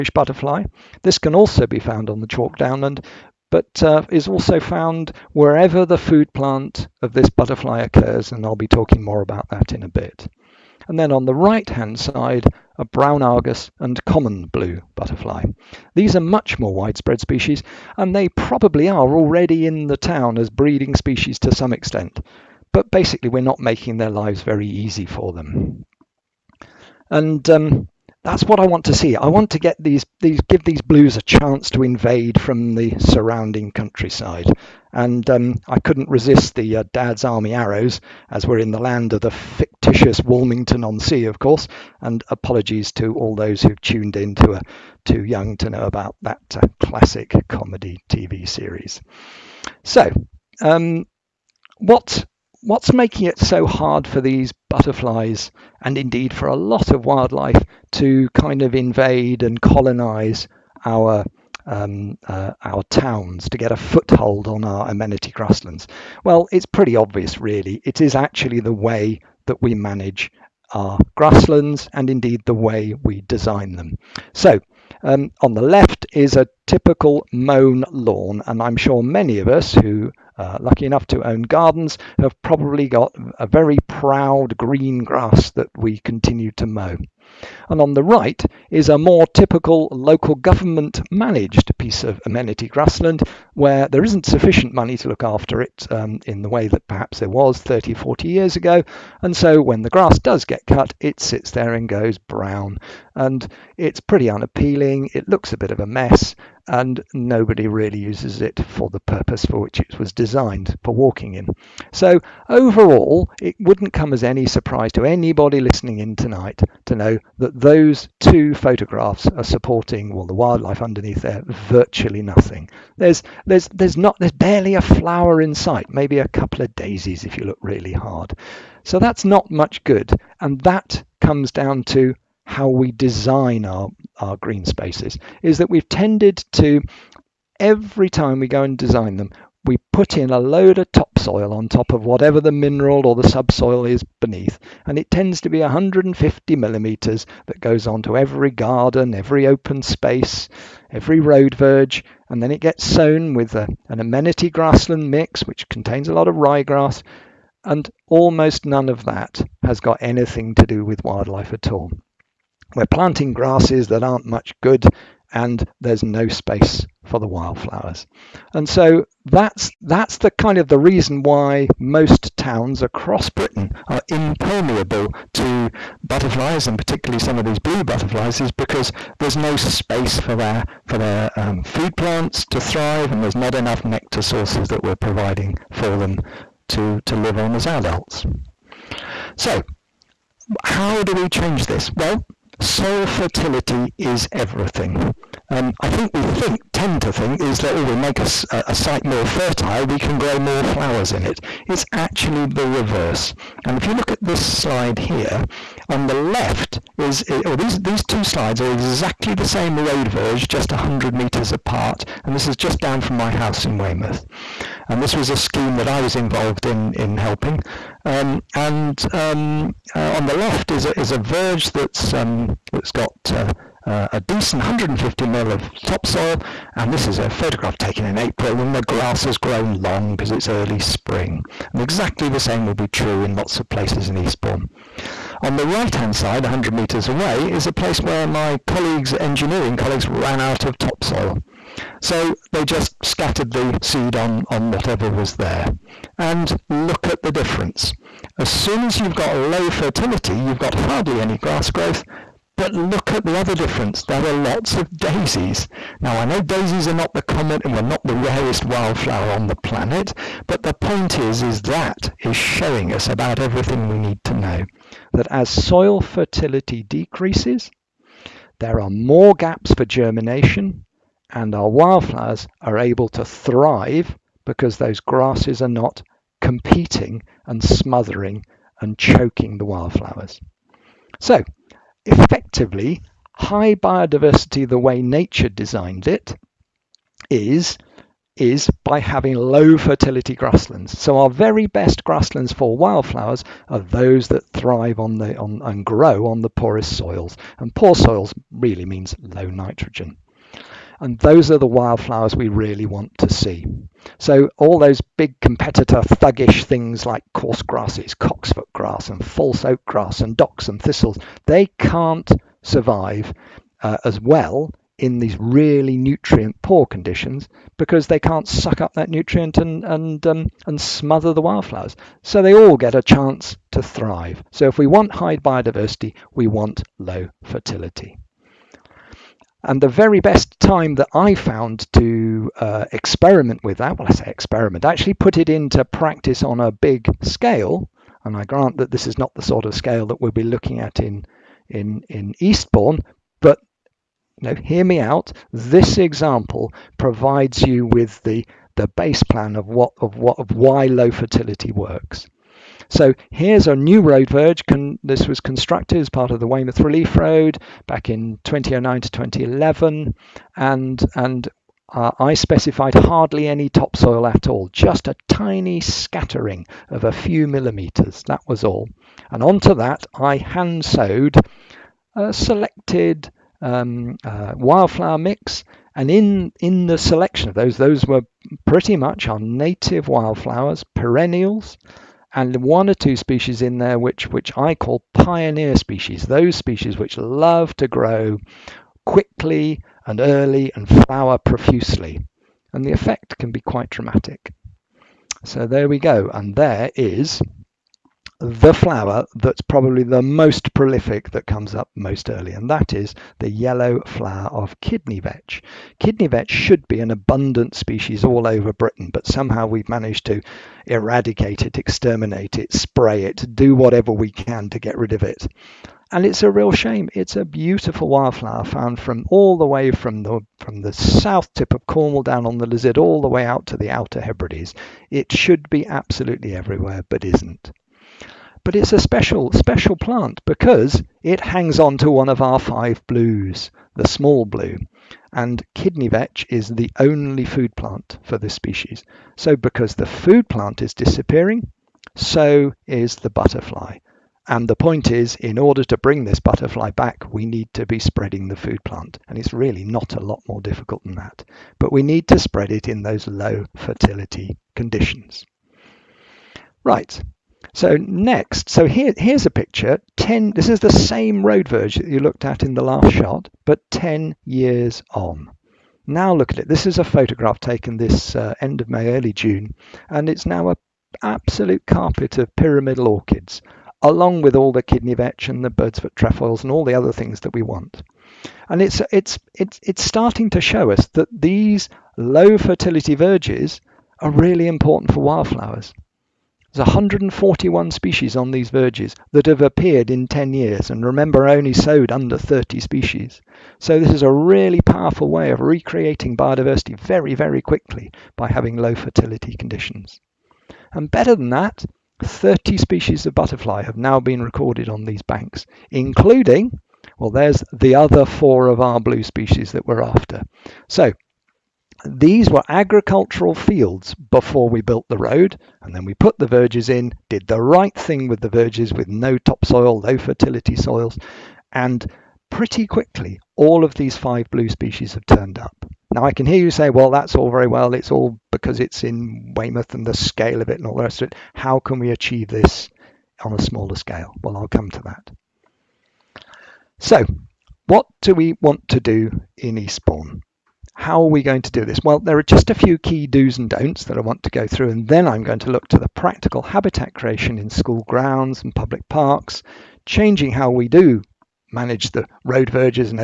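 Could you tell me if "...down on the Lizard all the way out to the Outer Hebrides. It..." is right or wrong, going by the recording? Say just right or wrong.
right.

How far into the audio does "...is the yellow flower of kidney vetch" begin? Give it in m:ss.
6:42.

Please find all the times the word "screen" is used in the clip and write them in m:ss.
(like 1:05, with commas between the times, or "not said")
not said.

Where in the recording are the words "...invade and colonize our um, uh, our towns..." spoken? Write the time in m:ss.
0:58.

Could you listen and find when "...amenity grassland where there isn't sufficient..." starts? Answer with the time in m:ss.
1:32.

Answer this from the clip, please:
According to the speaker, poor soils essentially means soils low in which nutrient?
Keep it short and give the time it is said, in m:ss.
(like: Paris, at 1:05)
nitrogen, at 4:59.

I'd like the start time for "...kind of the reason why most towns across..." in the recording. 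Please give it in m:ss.
2:50.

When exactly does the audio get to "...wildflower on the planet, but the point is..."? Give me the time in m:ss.
4:18.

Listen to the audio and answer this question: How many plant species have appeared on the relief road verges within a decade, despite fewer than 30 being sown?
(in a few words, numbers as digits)
141.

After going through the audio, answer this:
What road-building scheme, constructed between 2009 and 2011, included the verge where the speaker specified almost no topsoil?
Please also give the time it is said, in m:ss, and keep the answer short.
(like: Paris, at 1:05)
Weymouth Relief Road, at 5:56.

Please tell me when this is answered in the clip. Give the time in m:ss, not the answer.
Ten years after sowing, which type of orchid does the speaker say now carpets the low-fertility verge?
7:52.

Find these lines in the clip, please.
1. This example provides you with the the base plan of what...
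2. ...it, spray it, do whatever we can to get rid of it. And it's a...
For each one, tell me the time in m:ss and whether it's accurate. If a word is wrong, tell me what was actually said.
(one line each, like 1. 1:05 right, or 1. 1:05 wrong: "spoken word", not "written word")
1. 5:45 right
2. 6:52 right.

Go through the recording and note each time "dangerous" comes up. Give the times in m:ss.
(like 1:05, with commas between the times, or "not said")
not said.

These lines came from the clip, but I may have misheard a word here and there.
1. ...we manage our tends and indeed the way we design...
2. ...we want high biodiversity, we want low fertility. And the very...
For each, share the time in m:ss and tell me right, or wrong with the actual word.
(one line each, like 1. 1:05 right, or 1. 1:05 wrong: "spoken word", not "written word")
1. 1:09 wrong: "grasslands", not "tends"
2. 5:24 right.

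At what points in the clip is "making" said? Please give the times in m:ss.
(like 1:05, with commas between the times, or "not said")
0:23, 0:52.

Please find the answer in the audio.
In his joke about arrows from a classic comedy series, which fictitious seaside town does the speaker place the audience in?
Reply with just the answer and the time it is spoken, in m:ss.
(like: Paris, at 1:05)
Walmington on Sea, at 0:40.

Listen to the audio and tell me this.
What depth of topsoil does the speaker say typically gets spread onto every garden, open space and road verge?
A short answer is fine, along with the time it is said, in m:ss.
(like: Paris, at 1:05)
150 millimetres, at 2:25.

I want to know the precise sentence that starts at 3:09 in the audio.
So how do we change this?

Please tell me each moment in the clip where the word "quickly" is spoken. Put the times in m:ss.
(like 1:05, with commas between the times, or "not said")
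6:29, 8:17, 8:42.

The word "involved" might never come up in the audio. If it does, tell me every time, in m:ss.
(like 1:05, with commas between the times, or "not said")
3:36.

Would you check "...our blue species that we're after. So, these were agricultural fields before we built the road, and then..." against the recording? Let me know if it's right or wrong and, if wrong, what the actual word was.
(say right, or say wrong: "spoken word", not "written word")
right.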